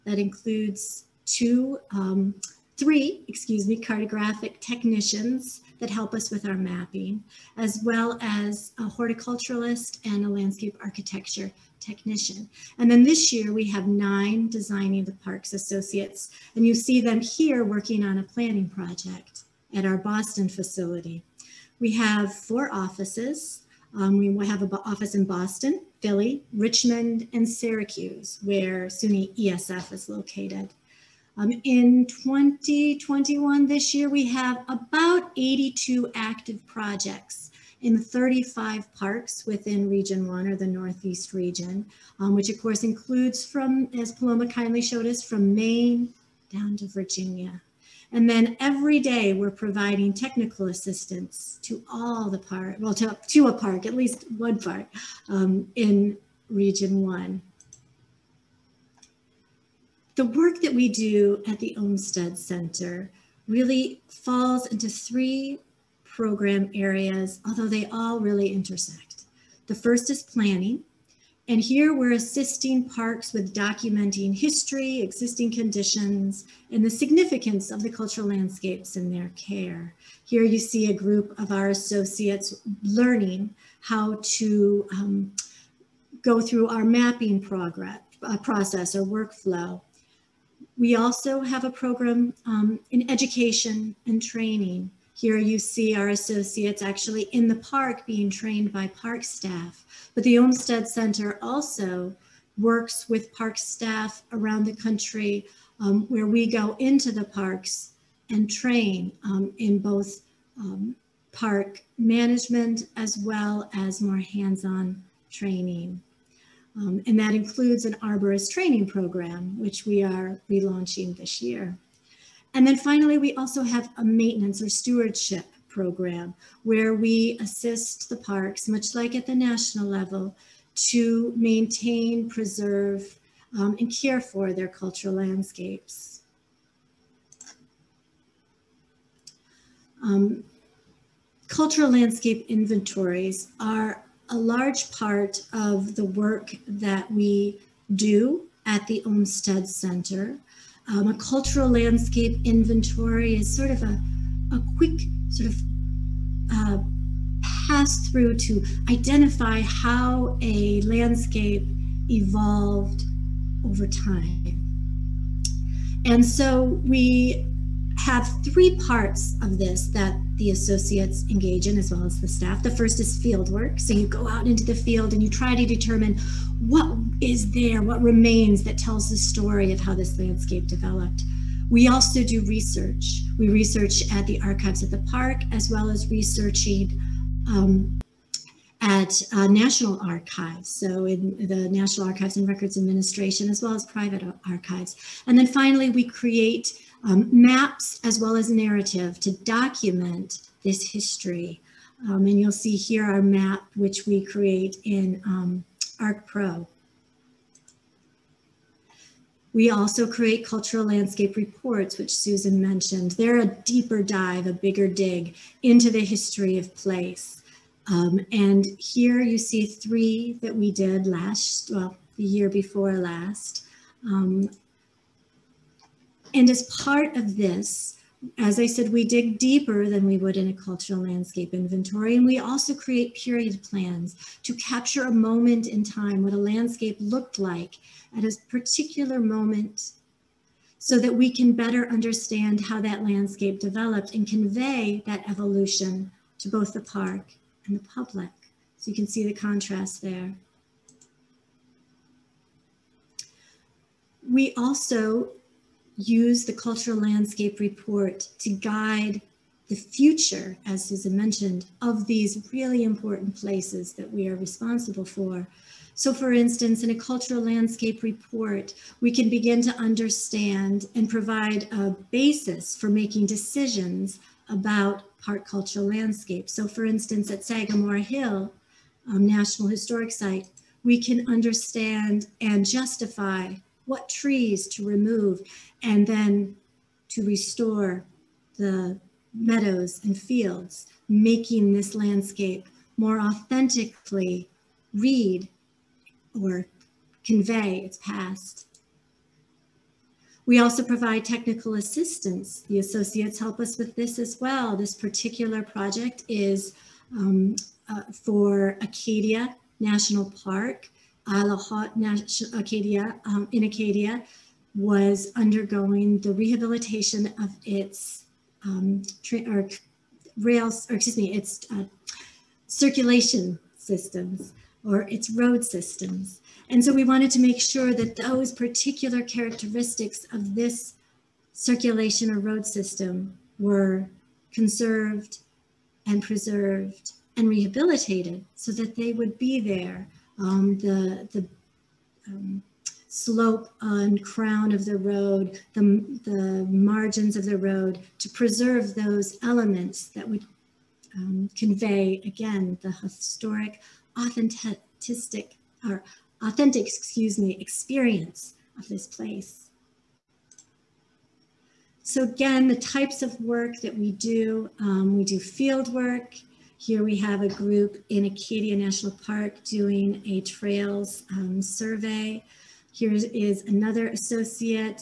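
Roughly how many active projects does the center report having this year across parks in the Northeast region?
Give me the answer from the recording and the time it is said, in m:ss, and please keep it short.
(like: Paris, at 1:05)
82, at 0:35.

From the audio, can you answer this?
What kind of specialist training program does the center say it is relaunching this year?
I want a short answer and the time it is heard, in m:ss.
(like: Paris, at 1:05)
arborist training program, at 1:58.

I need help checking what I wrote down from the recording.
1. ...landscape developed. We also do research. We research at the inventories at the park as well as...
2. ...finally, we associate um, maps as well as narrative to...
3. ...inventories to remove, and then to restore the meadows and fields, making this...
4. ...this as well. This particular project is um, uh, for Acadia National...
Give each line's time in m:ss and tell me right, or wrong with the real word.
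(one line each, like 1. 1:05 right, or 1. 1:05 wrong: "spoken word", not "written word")
1. 3:00 wrong: "archives", not "inventories"
2. 3:15 wrong: "create", not "associate"
3. 4:44 wrong: "trees", not "inventories"
4. 5:03 right.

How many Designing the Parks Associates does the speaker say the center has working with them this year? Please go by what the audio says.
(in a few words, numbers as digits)
9.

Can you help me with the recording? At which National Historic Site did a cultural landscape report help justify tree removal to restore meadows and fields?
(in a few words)
Sagamore Hill.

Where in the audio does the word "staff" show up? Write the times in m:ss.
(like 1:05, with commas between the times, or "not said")
1:39, 1:43, 2:52.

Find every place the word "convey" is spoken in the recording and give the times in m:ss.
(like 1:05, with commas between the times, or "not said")
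4:04, 4:57, 5:51.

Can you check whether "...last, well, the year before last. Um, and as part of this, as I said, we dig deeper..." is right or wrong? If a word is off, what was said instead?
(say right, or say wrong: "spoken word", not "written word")
right.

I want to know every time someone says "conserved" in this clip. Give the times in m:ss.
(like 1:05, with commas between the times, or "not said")
5:34.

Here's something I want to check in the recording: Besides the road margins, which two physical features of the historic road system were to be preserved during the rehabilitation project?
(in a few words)
slope and crown.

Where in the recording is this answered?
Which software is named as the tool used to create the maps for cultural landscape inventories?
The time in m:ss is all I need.
3:25.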